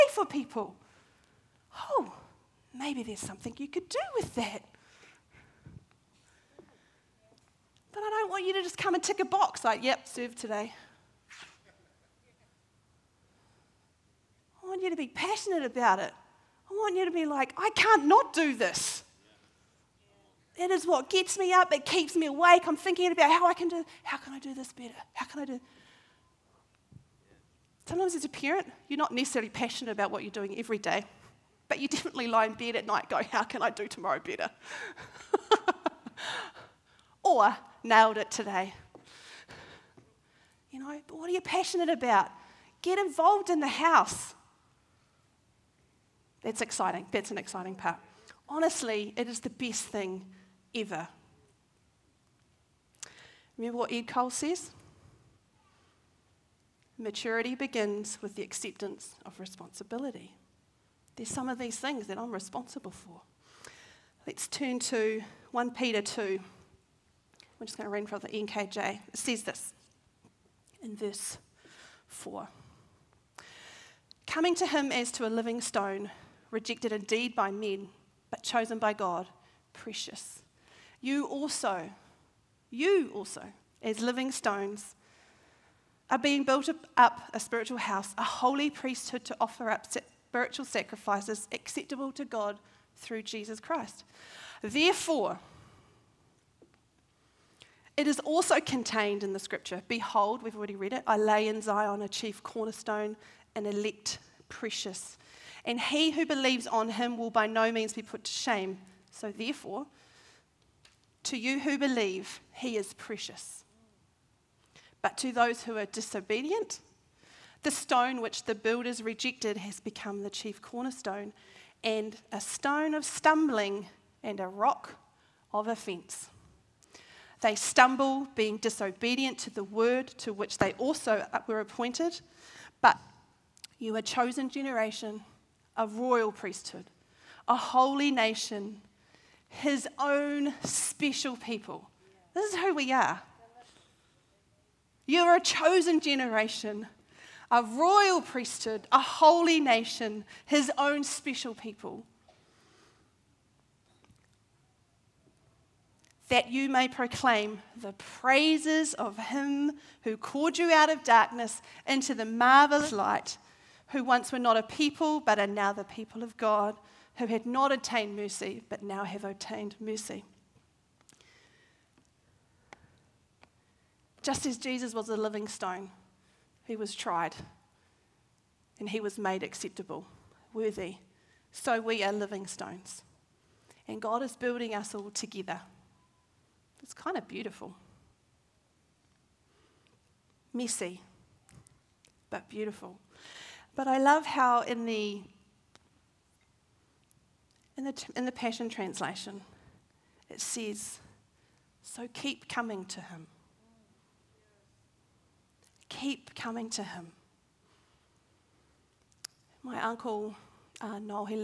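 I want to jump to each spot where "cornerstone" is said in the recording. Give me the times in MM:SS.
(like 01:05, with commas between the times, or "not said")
01:42, 02:00.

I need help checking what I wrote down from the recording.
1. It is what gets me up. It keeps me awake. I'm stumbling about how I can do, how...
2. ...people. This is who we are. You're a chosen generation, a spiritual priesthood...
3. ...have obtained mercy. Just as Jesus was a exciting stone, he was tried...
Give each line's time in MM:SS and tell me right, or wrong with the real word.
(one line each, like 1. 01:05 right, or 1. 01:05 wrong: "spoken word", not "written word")
1. 00:20 wrong: "thinking", not "stumbling"
2. 02:21 wrong: "royal", not "spiritual"
3. 02:49 wrong: "living", not "exciting".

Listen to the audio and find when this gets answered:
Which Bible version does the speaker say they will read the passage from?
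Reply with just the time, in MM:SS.
01:08.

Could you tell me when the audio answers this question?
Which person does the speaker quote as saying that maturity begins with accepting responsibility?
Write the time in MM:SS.
00:53.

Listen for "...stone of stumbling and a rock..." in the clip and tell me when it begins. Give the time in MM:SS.
02:02.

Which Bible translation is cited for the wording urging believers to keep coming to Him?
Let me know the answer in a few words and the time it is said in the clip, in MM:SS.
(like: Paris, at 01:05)
The Passion Translation, at 03:18.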